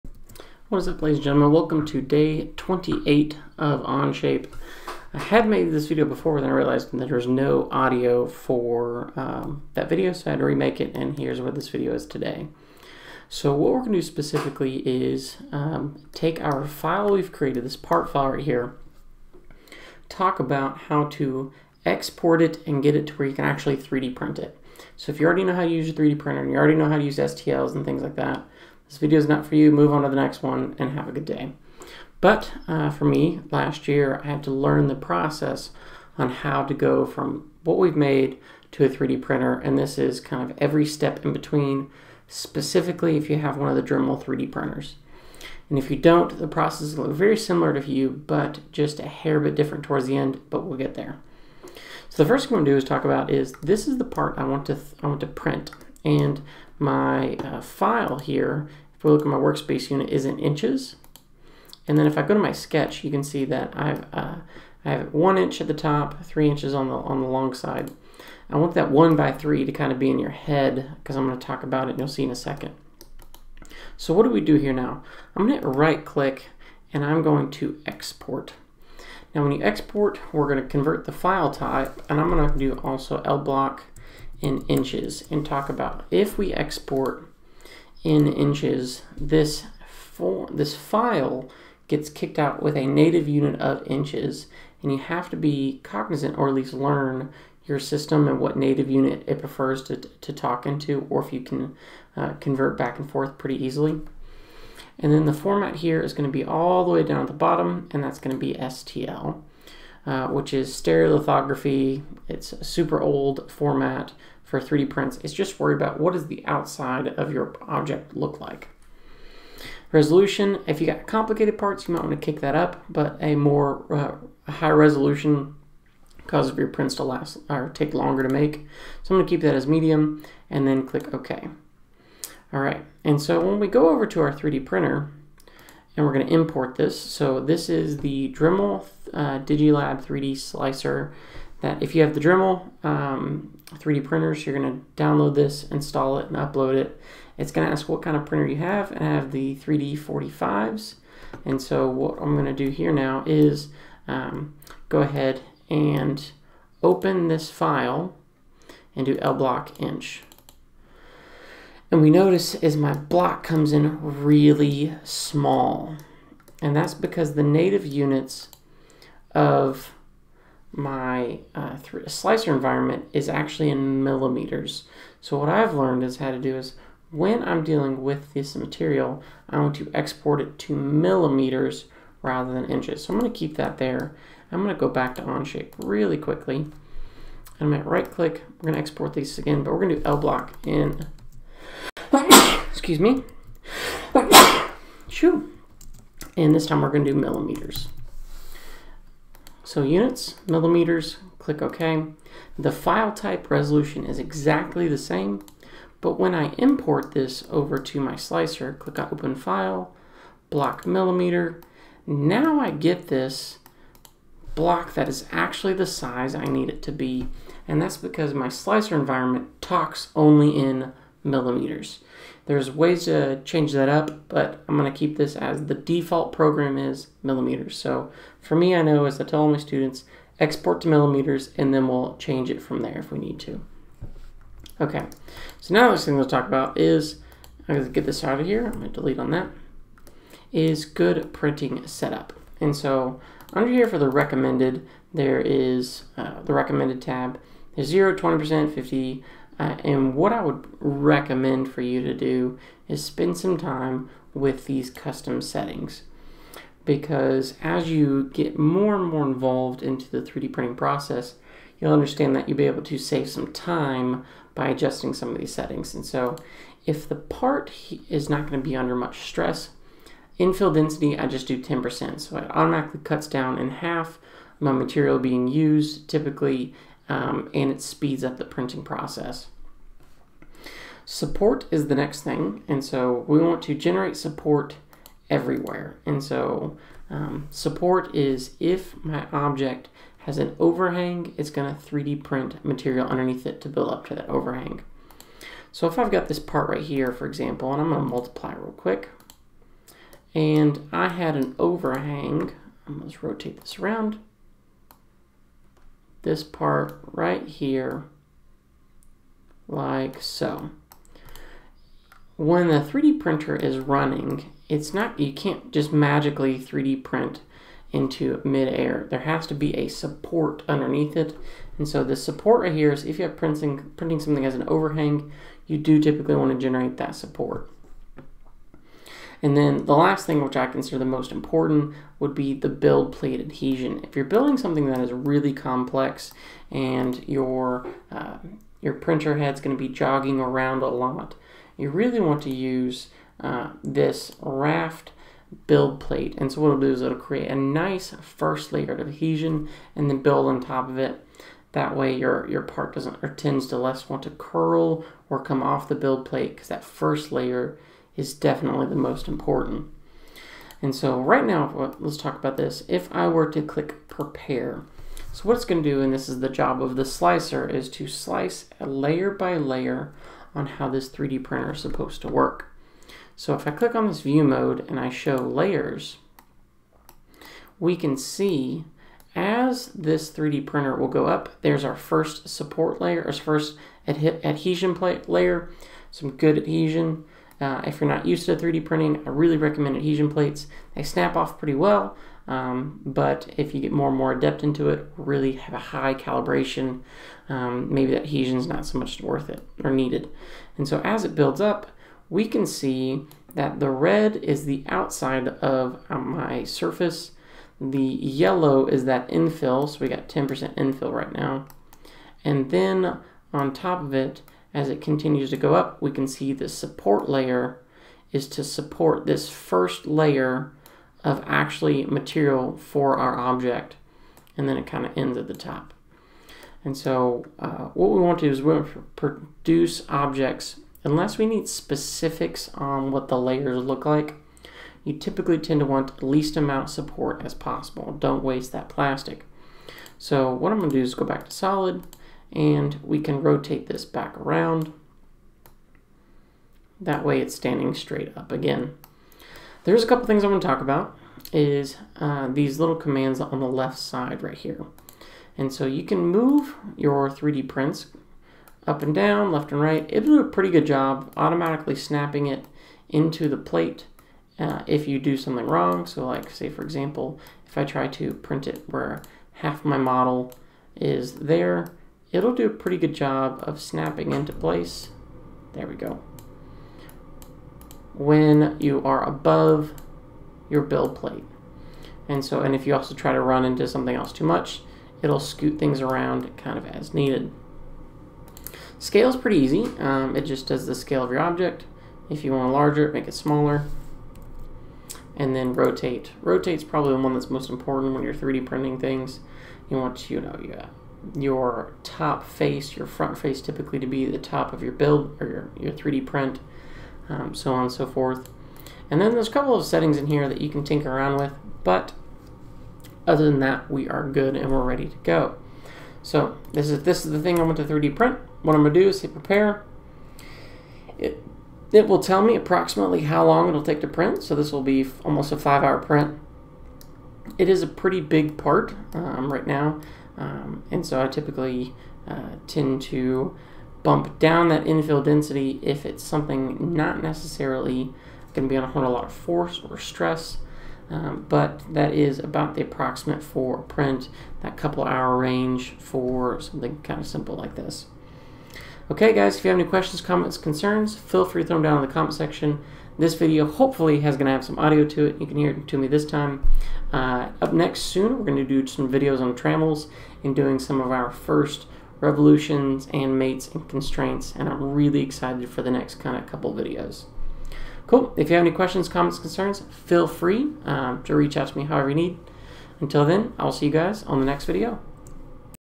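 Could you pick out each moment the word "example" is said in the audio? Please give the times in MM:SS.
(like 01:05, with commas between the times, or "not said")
04:57, 07:46.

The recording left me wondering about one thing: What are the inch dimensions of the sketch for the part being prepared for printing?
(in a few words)
1 by 3.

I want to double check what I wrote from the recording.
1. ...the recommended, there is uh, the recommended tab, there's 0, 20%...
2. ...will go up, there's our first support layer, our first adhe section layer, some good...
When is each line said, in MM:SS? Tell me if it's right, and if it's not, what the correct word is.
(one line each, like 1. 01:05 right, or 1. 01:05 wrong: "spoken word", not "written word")
1. 04:03 right
2. 06:20 wrong: "adhesion", not "section".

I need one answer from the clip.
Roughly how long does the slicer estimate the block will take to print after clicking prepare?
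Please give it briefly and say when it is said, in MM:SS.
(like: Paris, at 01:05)
Almost 5 hours, at 08:45.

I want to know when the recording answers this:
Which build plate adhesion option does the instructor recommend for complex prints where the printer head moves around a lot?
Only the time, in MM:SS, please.
05:44.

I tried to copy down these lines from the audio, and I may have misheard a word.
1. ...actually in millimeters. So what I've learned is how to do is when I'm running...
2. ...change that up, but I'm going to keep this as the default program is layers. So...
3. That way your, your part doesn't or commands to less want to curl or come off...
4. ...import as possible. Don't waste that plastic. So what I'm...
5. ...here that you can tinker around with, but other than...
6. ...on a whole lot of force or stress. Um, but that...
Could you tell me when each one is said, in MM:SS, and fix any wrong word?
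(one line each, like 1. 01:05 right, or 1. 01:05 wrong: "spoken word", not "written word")
1. 02:53 wrong: "dealing", not "running"
2. 03:43 wrong: "millimeters", not "layers"
3. 05:51 wrong: "tends", not "commands"
4. 07:16 wrong: "support", not "import"
5. 08:30 right
6. 08:58 right.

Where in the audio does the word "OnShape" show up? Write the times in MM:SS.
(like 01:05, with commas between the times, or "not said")
00:03, 03:05.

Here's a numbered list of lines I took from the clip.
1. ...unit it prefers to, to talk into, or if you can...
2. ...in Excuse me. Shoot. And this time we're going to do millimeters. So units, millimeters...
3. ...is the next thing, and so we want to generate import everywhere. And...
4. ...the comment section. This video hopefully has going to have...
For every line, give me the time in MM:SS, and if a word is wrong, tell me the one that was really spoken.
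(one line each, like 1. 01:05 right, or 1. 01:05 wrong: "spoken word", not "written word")
1. 01:38 right
2. 03:10 right
3. 04:41 wrong: "support", not "import"
4. 09:12 right.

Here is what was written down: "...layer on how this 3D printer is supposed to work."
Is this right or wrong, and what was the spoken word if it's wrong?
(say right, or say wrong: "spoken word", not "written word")
right.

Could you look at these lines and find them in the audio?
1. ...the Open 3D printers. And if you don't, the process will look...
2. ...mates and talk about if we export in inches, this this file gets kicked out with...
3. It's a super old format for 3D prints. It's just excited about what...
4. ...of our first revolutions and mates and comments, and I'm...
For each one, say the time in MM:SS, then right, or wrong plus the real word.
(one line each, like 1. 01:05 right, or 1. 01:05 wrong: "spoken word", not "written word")
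1. 00:43 wrong: "Dremel", not "Open"
2. 01:24 wrong: "inches", not "mates"
3. 01:52 wrong: "worried", not "excited"
4. 09:20 wrong: "constraints", not "comments".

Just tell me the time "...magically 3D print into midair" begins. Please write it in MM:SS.
05:15.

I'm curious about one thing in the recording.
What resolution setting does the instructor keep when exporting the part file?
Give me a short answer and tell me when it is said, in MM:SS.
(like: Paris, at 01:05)
Medium, at 02:09.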